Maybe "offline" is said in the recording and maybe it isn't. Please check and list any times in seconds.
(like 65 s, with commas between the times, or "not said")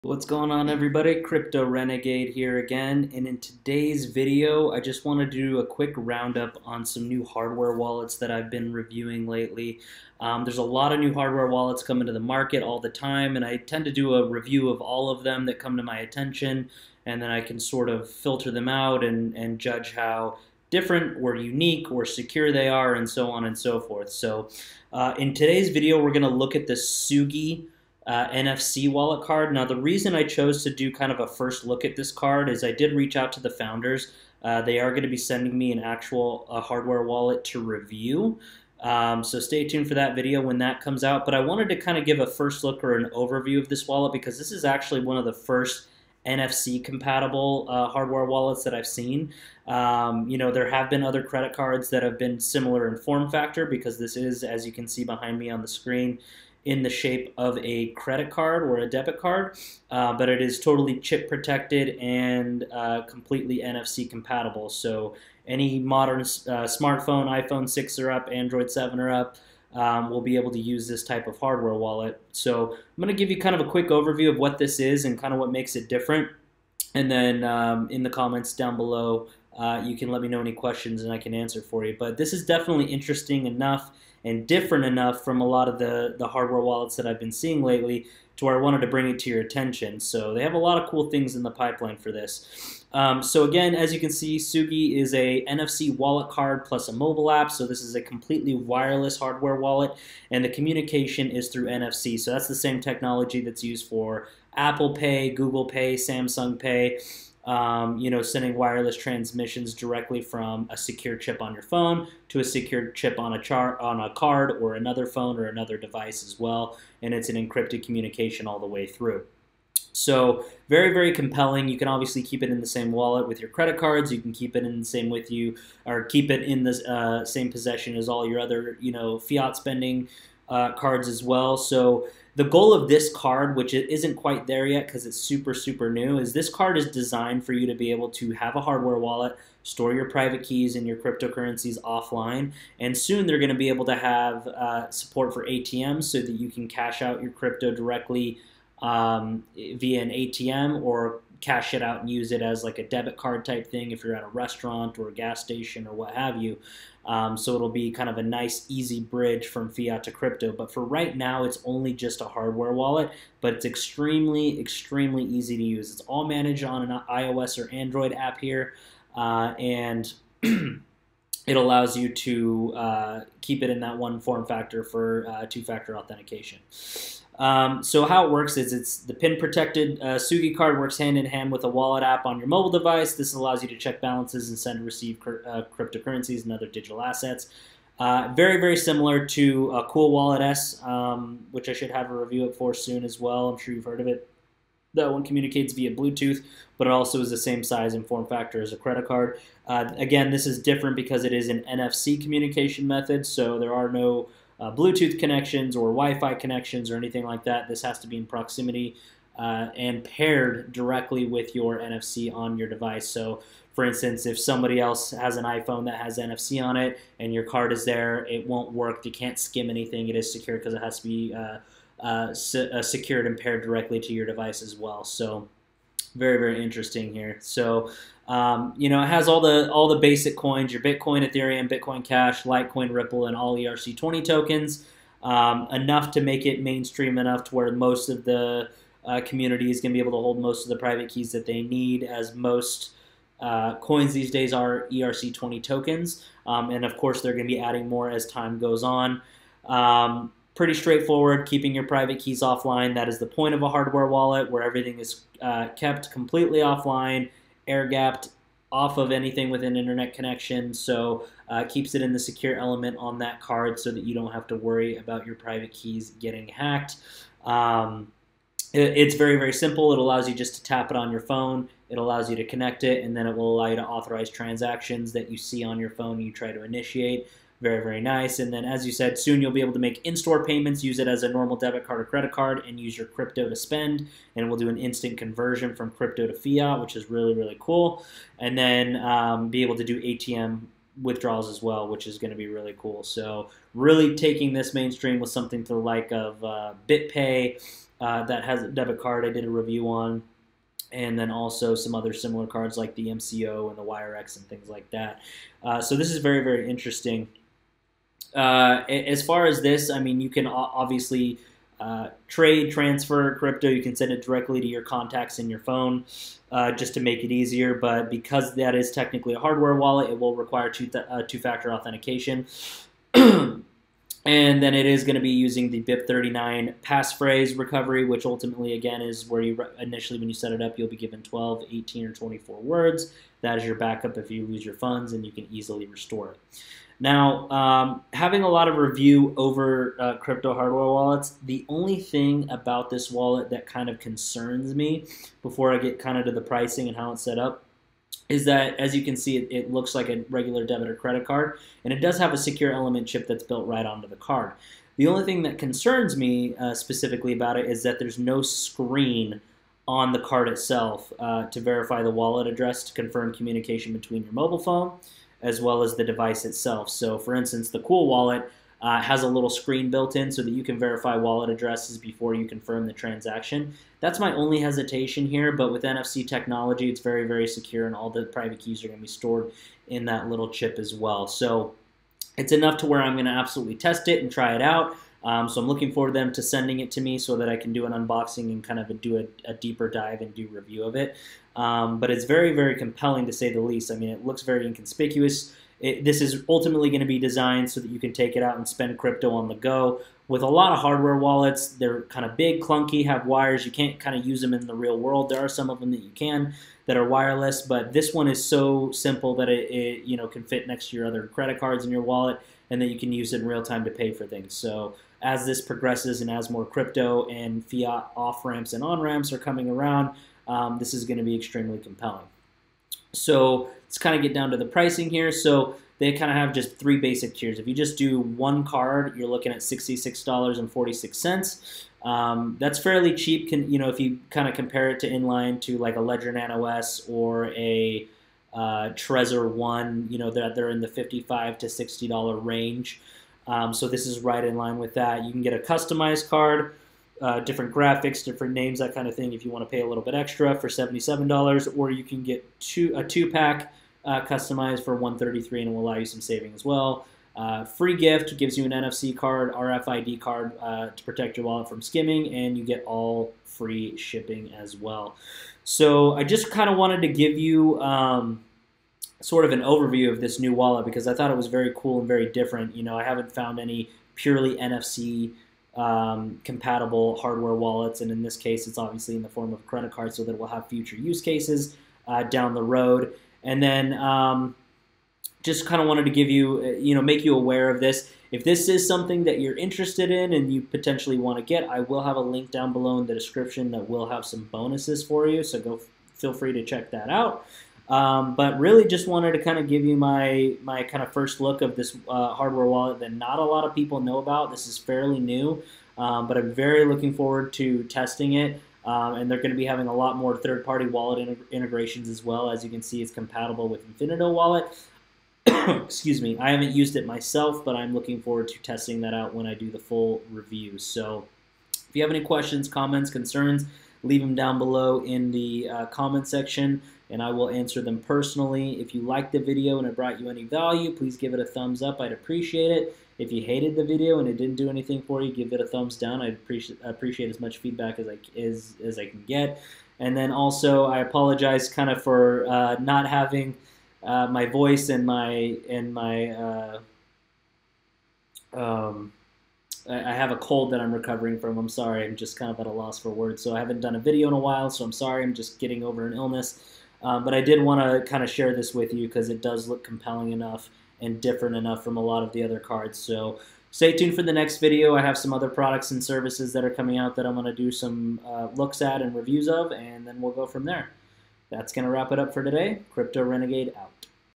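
141 s, 252 s, 256 s.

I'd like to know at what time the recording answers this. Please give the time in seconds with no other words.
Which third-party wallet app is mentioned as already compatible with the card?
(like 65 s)
513 s.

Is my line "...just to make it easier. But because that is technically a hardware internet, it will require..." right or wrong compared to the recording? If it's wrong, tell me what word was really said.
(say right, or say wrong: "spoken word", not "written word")
wrong: "wallet", not "internet".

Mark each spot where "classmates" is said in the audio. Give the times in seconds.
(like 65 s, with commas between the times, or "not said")
not said.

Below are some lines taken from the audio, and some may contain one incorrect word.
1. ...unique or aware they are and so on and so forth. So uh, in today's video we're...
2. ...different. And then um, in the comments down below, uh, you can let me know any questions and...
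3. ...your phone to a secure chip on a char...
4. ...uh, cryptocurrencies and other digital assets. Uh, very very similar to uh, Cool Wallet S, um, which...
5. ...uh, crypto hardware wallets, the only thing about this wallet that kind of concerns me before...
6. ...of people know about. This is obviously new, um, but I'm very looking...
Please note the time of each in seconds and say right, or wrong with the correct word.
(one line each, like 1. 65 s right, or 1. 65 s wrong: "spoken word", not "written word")
1. 21 s wrong: "secure", not "aware"
2. 75 s right
3. 111 s right
4. 185 s right
5. 339 s right
6. 503 s wrong: "fairly", not "obviously".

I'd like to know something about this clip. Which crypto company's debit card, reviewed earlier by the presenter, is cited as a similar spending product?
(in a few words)
BitPay.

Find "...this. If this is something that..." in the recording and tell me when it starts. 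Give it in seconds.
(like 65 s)
487 s.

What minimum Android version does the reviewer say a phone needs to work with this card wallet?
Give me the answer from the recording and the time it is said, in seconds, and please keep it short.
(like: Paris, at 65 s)
Android 7, at 68 s.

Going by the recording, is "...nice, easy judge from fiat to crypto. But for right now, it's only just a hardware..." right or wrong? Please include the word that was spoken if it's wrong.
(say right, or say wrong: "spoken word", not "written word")
wrong: "bridge", not "judge".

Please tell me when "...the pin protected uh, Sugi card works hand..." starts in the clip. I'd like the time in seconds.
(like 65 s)
178 s.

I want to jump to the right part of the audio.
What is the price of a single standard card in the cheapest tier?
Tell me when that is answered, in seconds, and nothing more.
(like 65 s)
429 s.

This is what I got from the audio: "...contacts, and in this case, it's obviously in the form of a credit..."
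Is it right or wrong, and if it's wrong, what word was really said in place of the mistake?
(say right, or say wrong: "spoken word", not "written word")
wrong: "wallets", not "contacts".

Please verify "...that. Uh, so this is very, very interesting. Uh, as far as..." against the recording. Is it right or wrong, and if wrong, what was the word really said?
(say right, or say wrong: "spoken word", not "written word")
right.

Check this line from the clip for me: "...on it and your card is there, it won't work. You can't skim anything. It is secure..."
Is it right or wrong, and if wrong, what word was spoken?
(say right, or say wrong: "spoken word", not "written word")
right.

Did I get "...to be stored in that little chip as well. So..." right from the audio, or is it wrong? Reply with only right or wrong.
right.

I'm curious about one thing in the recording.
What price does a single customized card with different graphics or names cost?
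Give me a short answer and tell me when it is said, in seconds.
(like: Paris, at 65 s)
$77, at 450 s.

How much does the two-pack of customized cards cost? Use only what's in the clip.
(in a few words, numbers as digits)
$133.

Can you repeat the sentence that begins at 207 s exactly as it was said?
This has to be in proximity uh, and paired directly with your NFC on your device.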